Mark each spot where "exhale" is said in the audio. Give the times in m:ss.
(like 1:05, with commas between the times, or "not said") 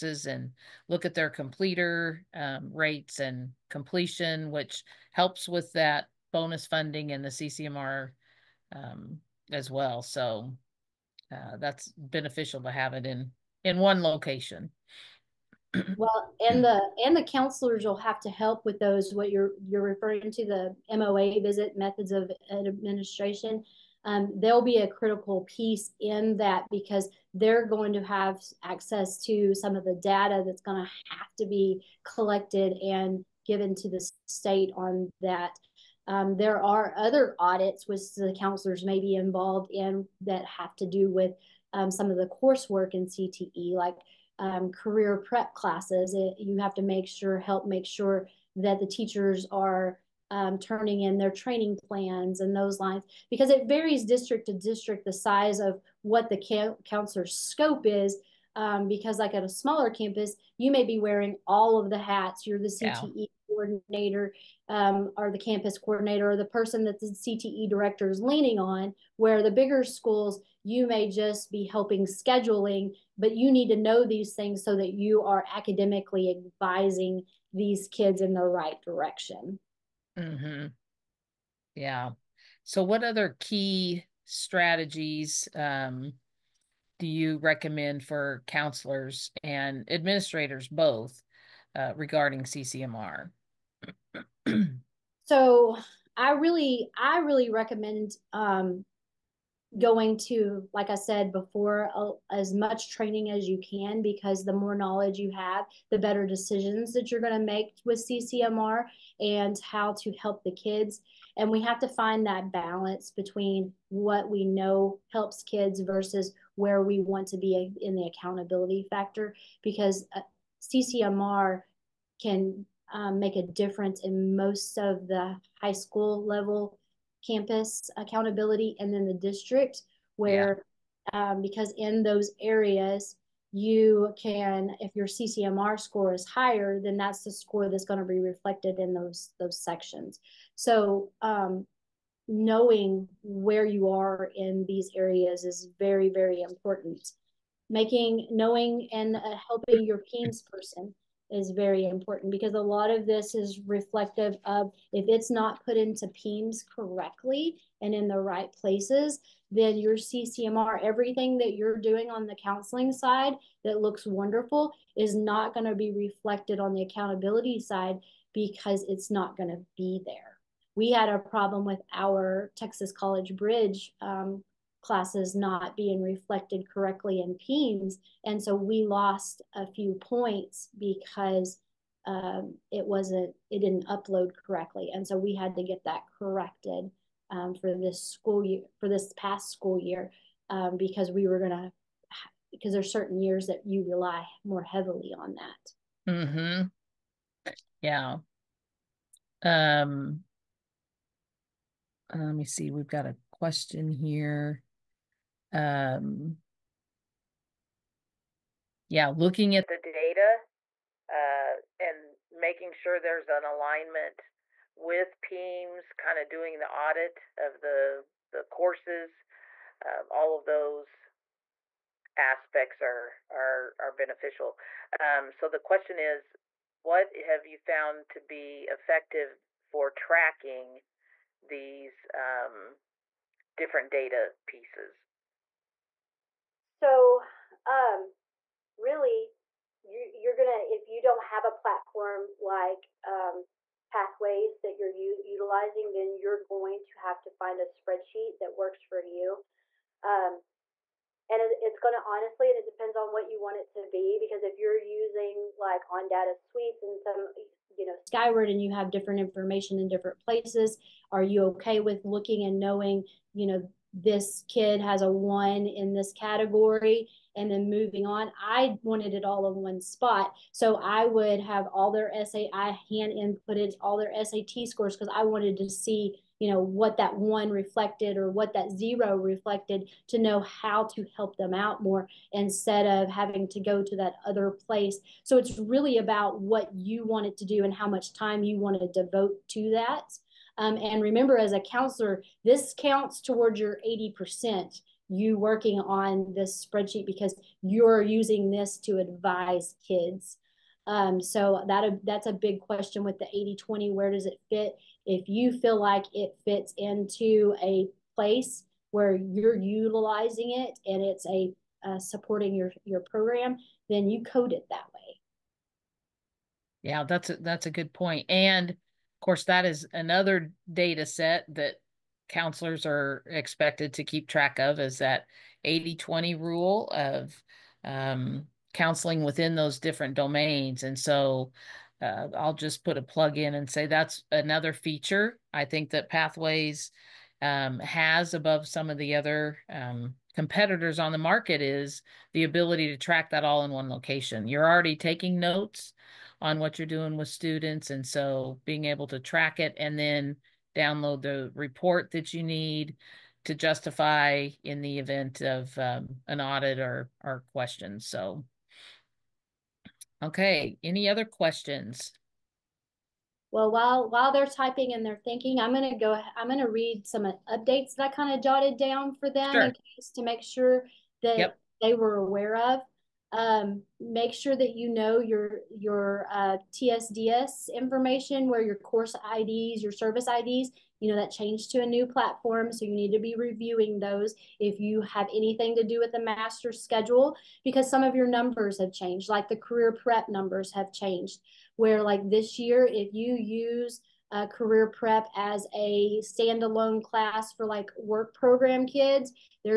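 not said.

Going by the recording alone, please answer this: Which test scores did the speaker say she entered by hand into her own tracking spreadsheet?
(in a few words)
SAT scores.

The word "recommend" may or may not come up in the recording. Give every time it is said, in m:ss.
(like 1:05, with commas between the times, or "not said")
1:27, 1:37.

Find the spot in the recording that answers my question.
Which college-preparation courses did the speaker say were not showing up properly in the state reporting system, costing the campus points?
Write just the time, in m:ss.
2:52.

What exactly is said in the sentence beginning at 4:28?
I wanted it all in one spot.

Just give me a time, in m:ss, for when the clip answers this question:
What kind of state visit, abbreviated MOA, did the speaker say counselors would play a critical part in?
0:21.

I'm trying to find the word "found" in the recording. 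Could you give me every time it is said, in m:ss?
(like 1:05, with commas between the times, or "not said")
3:47.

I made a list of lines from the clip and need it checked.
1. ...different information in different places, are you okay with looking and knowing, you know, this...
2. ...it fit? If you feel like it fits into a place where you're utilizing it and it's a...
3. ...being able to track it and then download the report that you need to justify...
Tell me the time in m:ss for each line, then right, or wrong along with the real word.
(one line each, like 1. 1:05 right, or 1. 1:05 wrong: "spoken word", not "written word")
1. 4:18 right
2. 5:04 right
3. 5:48 right.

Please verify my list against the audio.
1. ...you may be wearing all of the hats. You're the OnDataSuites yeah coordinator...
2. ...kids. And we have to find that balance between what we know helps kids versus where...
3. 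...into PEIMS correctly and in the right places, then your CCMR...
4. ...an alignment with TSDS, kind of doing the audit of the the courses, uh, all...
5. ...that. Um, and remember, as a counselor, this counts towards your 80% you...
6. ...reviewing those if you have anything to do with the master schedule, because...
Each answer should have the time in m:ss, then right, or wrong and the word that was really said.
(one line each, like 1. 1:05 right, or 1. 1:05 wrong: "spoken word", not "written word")
1. 1:00 wrong: "CTE", not "OnDataSuites"
2. 1:50 right
3. 2:35 right
4. 3:33 wrong: "PEIMS", not "TSDS"
5. 4:49 right
6. 6:23 right.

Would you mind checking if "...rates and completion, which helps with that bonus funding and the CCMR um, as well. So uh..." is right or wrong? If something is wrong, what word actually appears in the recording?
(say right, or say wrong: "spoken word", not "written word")
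right.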